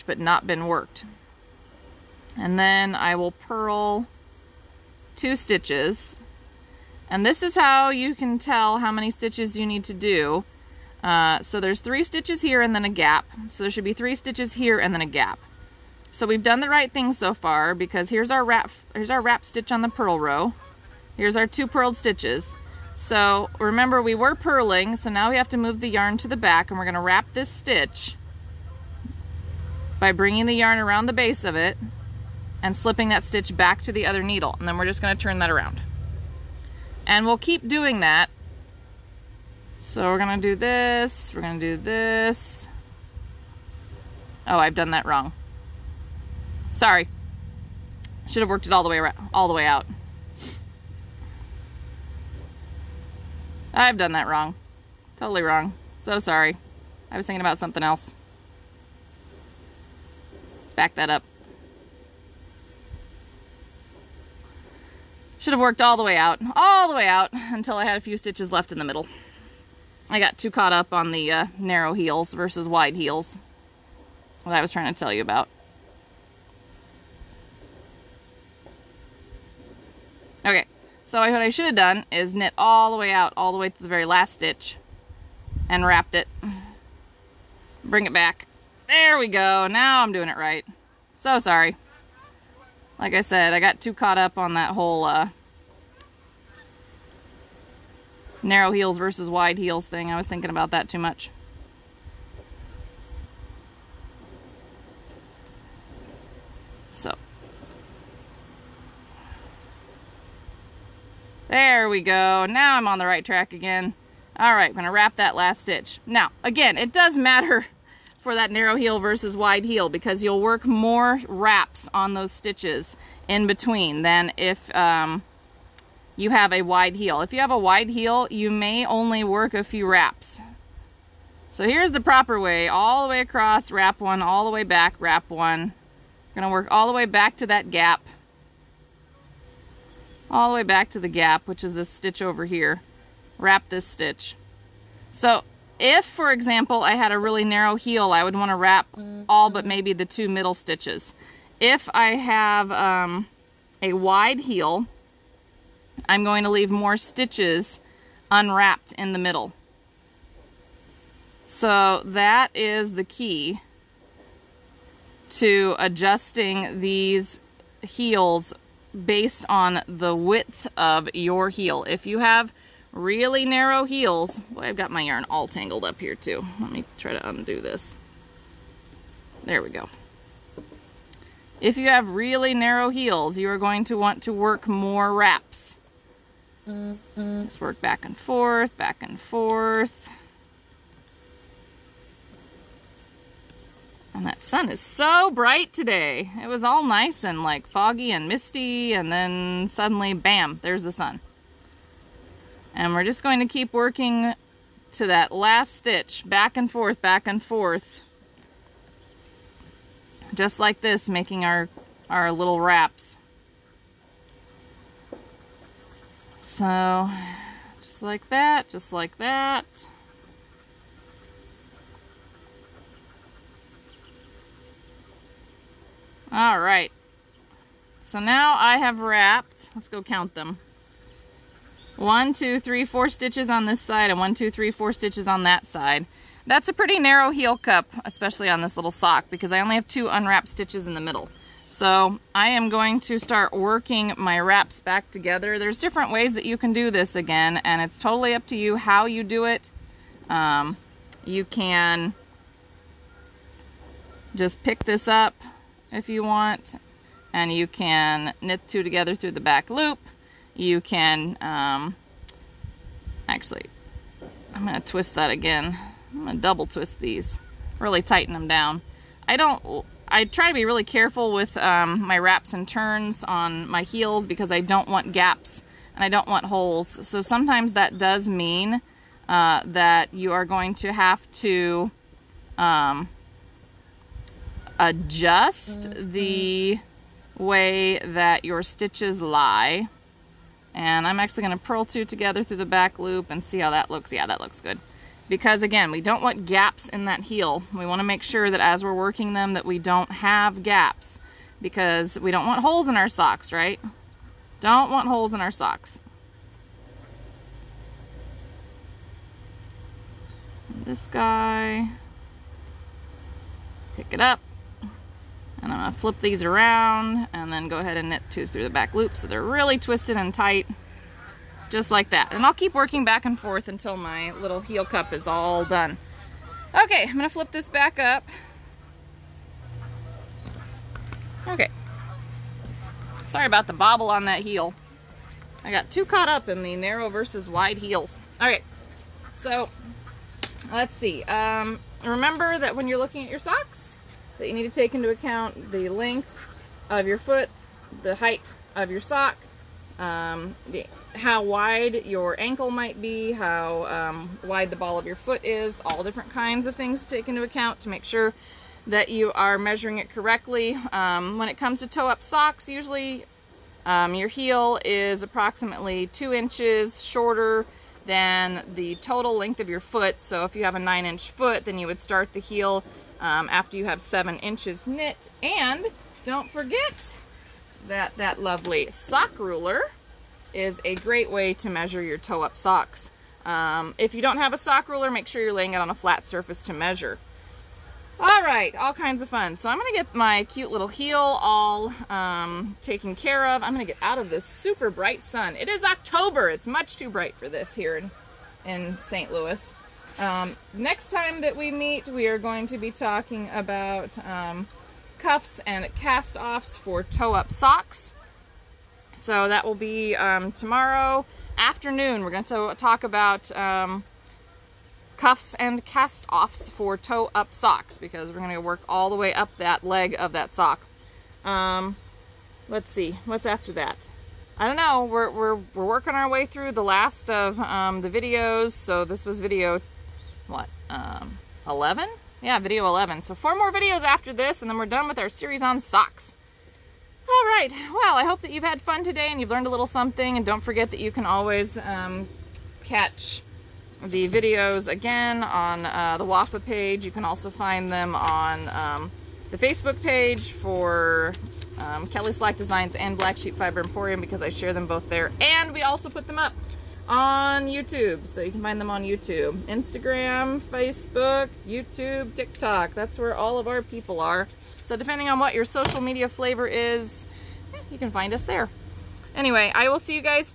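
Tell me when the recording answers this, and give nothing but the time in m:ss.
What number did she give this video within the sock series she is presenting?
7:12.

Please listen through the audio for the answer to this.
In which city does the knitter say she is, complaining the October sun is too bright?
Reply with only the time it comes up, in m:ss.
6:39.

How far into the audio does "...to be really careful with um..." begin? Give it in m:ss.
4:30.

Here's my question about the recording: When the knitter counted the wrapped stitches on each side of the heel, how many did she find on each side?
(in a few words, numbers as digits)
4.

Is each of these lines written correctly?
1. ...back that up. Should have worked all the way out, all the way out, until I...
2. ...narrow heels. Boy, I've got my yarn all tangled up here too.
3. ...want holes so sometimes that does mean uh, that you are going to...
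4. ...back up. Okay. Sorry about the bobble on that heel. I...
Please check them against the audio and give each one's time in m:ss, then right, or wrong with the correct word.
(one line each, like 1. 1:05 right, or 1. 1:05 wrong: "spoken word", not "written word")
1. 1:00 right
2. 2:53 right
3. 4:36 right
4. 5:27 right.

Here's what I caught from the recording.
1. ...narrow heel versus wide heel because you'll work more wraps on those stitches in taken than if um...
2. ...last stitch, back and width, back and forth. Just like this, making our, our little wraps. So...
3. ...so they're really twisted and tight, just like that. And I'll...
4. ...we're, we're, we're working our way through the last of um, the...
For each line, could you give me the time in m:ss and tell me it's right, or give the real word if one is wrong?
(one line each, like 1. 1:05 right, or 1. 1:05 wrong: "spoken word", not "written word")
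1. 1:58 wrong: "between", not "taken"
2. 3:25 wrong: "forth", not "width"
3. 5:19 right
4. 7:05 right.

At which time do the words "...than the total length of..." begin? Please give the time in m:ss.
6:08.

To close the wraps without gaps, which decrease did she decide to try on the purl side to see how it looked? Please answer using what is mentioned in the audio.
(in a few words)
purl two together through the back loop.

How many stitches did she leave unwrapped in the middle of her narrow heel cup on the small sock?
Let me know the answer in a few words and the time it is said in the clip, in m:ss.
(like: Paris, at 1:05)
2, at 3:59.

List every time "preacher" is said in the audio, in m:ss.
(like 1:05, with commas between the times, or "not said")
not said.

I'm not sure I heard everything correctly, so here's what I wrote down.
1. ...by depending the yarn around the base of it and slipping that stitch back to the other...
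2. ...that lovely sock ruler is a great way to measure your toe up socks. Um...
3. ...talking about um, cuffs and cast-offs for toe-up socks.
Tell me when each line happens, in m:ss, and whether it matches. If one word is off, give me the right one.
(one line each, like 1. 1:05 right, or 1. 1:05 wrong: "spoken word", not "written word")
1. 0:29 wrong: "bringing", not "depending"
2. 6:18 right
3. 6:42 right.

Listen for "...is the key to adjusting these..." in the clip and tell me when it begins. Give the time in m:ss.
2:42.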